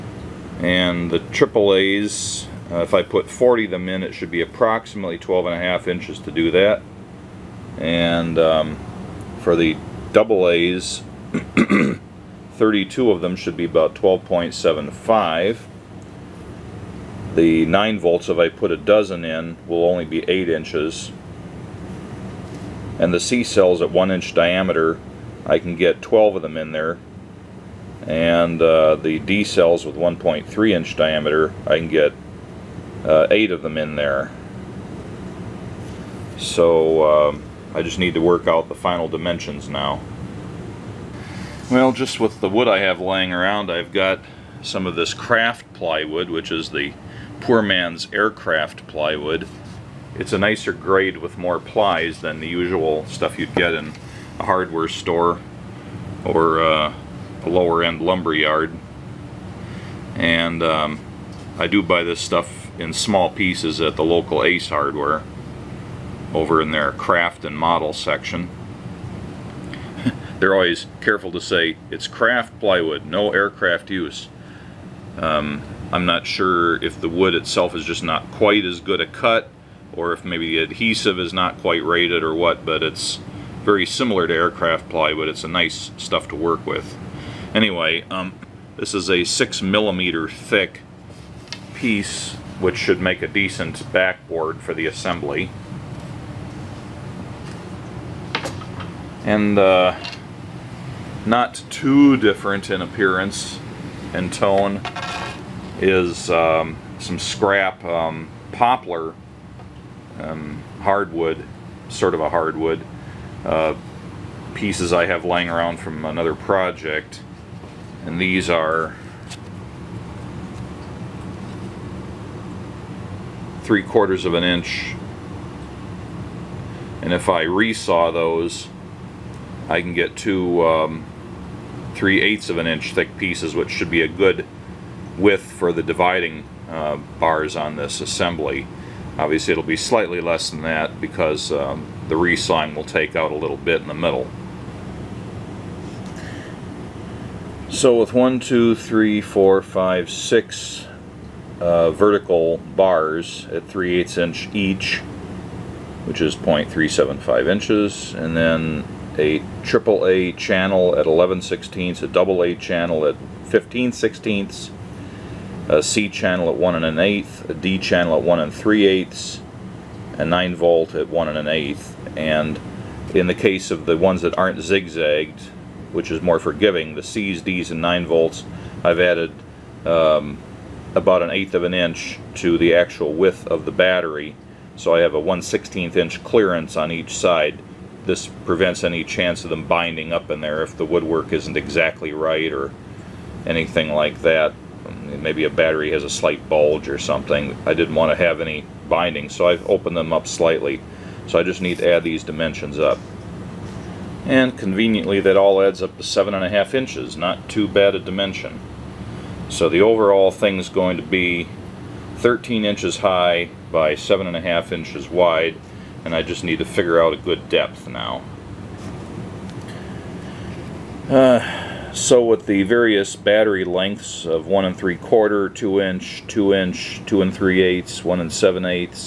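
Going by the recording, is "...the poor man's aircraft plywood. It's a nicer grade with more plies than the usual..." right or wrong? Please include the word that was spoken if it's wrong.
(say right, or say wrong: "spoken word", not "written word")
right.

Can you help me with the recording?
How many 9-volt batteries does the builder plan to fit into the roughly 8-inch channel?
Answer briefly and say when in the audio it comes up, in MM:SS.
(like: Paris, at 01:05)
12, at 00:18.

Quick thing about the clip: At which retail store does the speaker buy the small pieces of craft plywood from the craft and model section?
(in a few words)
Ace Hardware.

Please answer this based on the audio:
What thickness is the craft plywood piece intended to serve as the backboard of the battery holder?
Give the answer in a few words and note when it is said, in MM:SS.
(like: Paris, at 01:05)
6 millimeters, at 01:29.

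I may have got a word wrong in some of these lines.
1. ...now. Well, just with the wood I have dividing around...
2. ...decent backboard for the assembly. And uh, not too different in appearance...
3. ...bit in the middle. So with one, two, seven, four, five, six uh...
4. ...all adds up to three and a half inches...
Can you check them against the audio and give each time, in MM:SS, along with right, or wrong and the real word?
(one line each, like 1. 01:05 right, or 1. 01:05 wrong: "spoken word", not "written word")
1. 00:39 wrong: "laying", not "dividing"
2. 01:33 right
3. 02:23 wrong: "three", not "seven"
4. 03:25 wrong: "seven", not "three".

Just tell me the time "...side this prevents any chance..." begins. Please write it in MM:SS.
03:07.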